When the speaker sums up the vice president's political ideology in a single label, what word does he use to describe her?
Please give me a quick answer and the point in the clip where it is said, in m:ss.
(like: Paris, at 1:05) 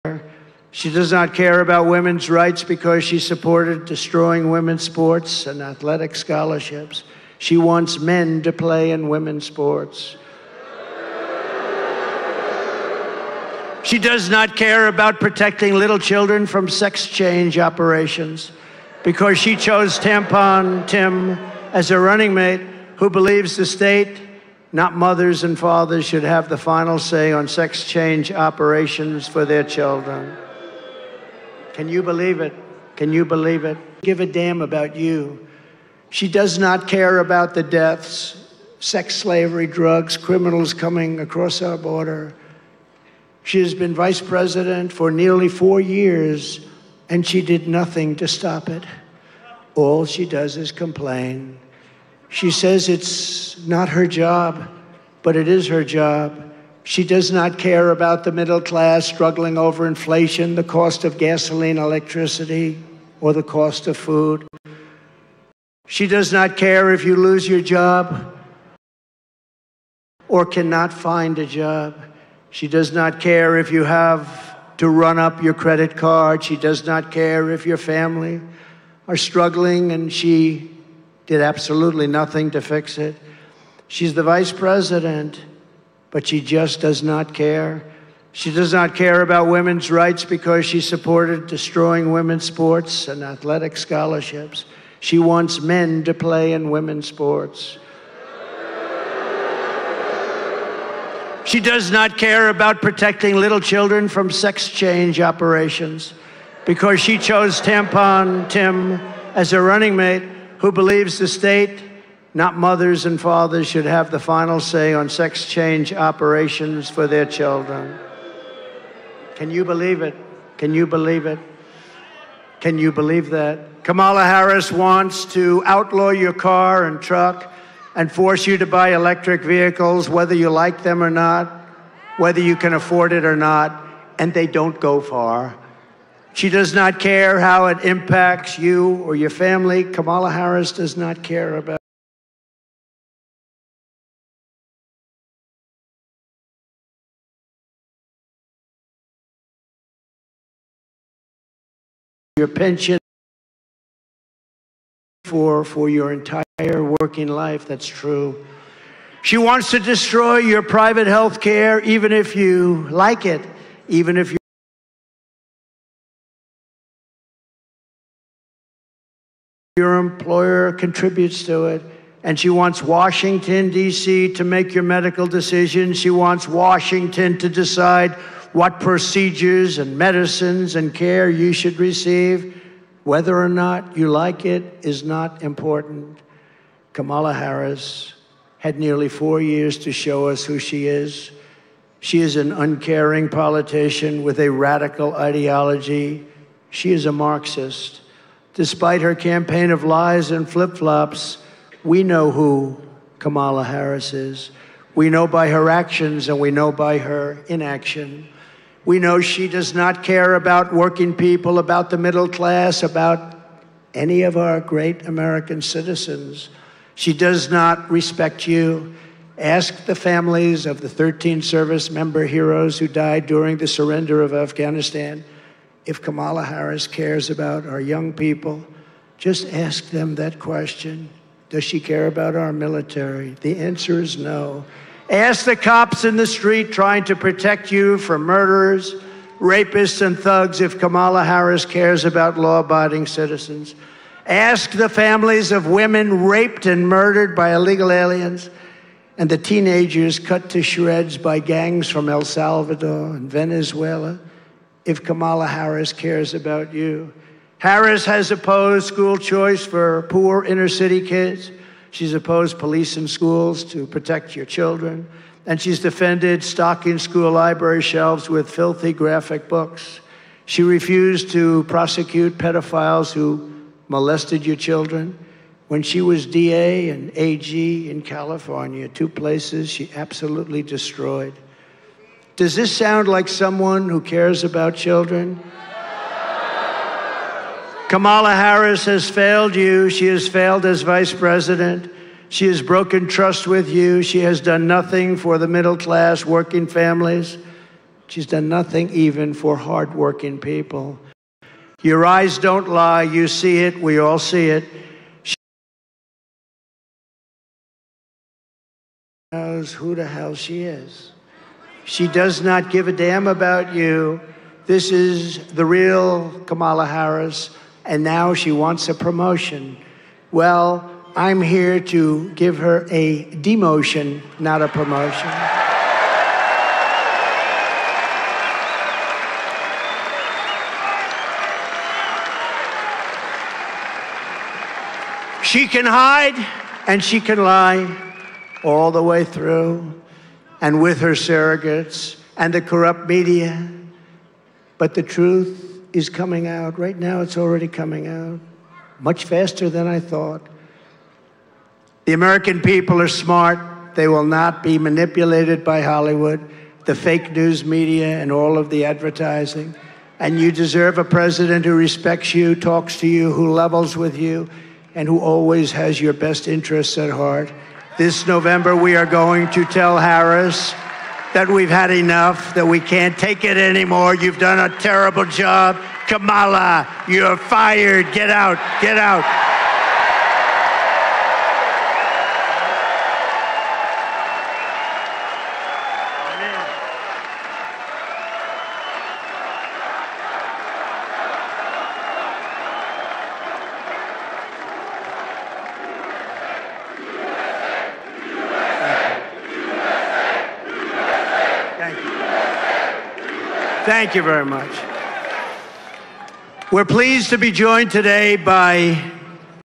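Marxist, at 3:17.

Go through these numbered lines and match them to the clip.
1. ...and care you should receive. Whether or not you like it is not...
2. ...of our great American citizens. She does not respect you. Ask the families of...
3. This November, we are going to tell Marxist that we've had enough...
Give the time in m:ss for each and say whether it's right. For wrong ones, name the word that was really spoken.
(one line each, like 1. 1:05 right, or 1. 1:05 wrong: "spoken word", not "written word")
1. 3:00 right
2. 3:34 right
3. 6:07 wrong: "Harris", not "Marxist".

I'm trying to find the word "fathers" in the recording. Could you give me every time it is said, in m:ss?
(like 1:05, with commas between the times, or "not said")
0:25, 1:53.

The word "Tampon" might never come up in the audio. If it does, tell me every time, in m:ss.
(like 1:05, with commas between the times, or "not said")
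0:19, 1:47.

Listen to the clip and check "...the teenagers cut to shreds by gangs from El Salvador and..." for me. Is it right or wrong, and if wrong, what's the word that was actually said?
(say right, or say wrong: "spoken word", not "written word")
right.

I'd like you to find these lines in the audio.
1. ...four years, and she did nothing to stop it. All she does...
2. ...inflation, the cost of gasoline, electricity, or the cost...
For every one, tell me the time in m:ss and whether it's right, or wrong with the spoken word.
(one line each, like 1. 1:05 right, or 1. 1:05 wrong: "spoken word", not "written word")
1. 0:45 right
2. 0:59 right.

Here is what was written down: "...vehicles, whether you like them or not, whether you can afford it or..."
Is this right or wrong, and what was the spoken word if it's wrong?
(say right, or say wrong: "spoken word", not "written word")
right.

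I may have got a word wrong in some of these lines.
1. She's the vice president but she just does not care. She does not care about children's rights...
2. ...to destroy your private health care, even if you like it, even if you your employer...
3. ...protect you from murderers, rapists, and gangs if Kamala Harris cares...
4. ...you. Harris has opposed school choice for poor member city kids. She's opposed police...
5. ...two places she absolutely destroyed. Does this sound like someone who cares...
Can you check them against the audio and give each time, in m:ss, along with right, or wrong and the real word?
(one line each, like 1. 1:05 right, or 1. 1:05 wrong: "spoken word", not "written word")
1. 1:23 wrong: "women", not "children"
2. 2:39 right
3. 3:57 wrong: "thugs", not "gangs"
4. 4:16 wrong: "inner", not "member"
5. 4:38 right.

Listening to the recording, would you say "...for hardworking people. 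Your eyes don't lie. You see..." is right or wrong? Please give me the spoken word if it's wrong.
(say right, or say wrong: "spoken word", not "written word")
right.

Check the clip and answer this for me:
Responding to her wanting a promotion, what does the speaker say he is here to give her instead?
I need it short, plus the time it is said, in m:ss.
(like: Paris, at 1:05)
a demotion, at 5:23.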